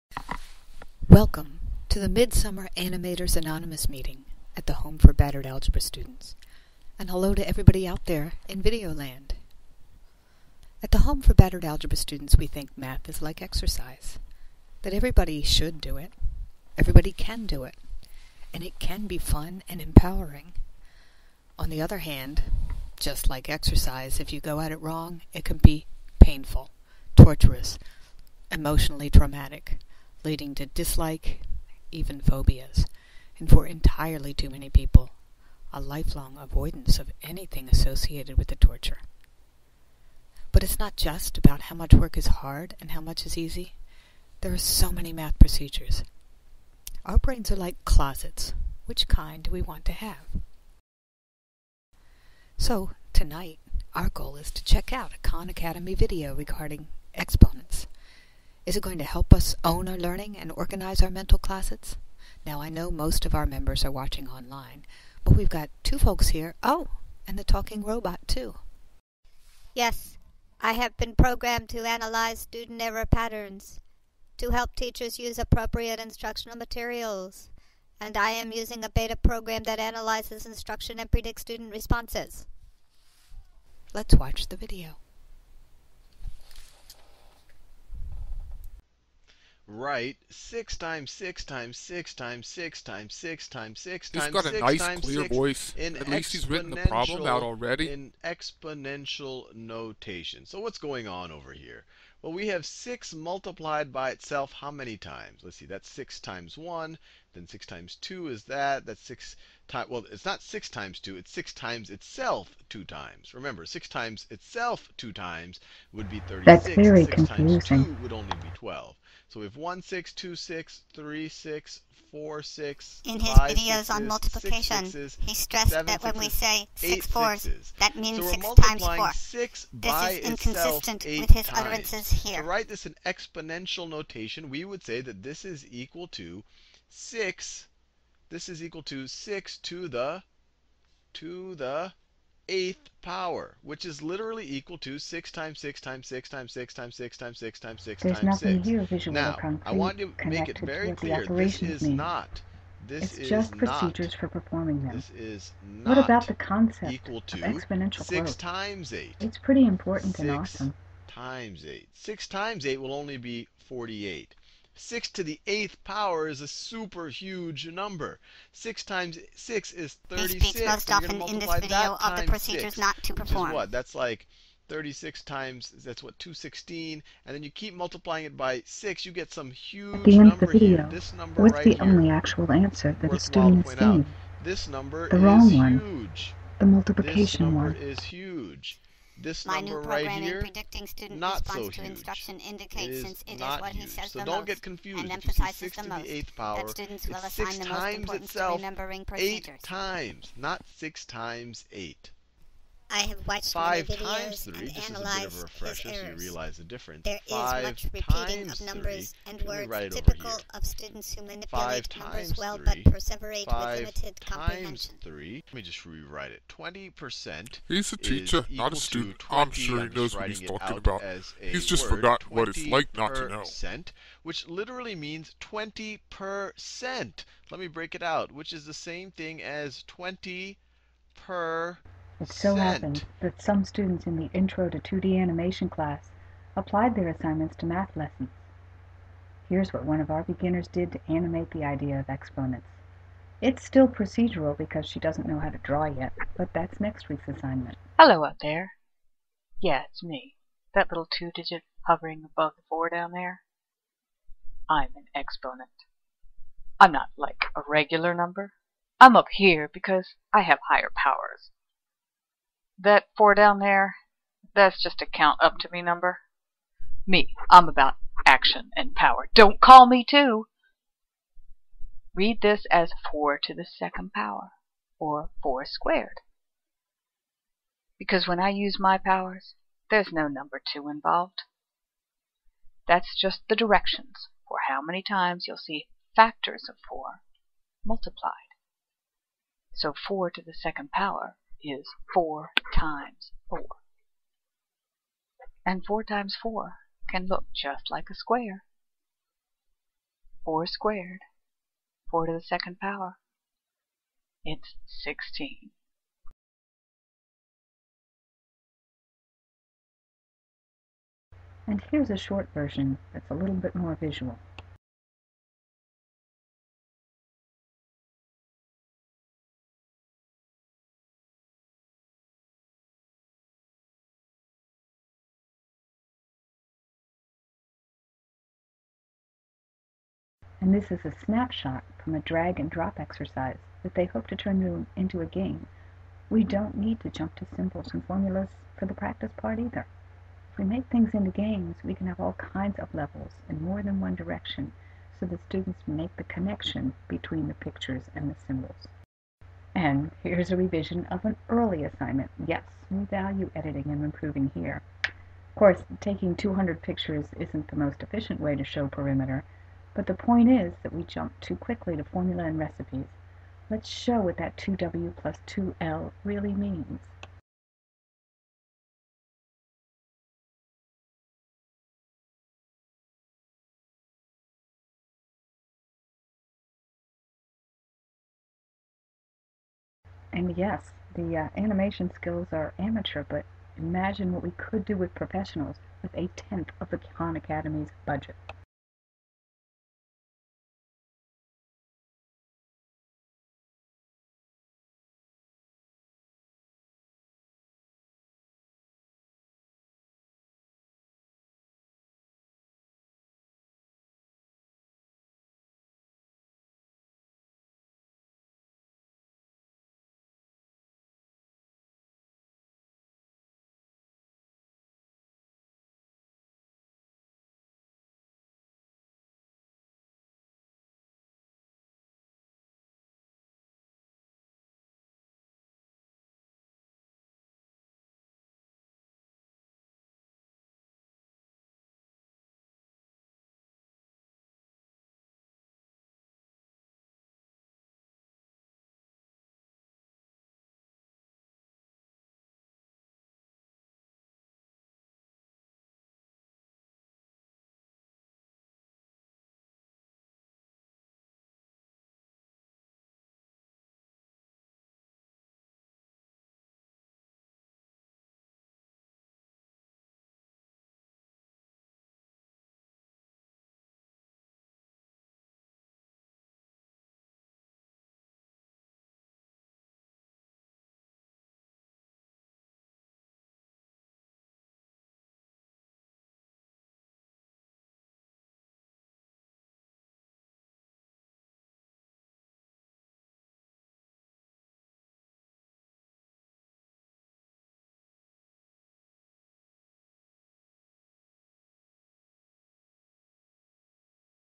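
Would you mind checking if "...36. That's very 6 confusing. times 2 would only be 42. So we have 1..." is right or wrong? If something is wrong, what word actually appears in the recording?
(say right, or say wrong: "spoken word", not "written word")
wrong: "12", not "42".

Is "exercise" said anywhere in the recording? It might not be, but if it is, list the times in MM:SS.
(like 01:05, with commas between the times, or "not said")
00:13, 00:23, 05:32.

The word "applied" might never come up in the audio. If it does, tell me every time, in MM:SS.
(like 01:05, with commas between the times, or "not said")
03:56.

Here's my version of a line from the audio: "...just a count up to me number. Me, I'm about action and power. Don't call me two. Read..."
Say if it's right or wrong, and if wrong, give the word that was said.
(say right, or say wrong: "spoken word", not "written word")
right.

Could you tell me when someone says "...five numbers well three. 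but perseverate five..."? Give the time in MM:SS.
03:31.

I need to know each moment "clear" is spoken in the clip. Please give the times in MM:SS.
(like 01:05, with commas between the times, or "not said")
01:35, 02:30.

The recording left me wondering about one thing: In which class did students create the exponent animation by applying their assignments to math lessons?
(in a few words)
Intro to 2D Animation.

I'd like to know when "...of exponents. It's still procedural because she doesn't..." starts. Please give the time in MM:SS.
04:01.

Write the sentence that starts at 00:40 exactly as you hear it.
But it's not just about how much work is hard and how much is easy.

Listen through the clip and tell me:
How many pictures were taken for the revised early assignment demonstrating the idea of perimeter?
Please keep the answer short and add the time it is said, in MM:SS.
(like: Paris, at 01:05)
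200, at 05:56.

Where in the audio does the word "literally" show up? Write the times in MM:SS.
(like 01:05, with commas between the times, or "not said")
02:24, 03:44.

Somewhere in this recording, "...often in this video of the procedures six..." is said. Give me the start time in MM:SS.
02:50.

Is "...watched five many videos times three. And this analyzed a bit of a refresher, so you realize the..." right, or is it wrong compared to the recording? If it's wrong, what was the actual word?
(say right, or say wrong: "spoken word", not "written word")
right.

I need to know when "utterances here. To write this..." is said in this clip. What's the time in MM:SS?
02:11.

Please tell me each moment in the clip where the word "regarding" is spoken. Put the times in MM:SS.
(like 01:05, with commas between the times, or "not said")
00:56.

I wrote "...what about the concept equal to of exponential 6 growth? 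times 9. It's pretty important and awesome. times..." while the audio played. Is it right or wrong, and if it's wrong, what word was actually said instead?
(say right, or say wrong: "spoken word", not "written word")
wrong: "8", not "9".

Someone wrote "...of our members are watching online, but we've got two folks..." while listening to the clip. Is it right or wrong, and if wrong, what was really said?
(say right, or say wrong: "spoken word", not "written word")
right.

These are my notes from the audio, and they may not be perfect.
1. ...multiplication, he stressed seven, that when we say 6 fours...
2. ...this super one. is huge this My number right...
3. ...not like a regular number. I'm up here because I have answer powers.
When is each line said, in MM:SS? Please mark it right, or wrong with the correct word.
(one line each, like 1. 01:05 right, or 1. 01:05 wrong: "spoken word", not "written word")
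1. 02:04 right
2. 03:07 wrong: "number", not "super"
3. 04:16 wrong: "higher", not "answer".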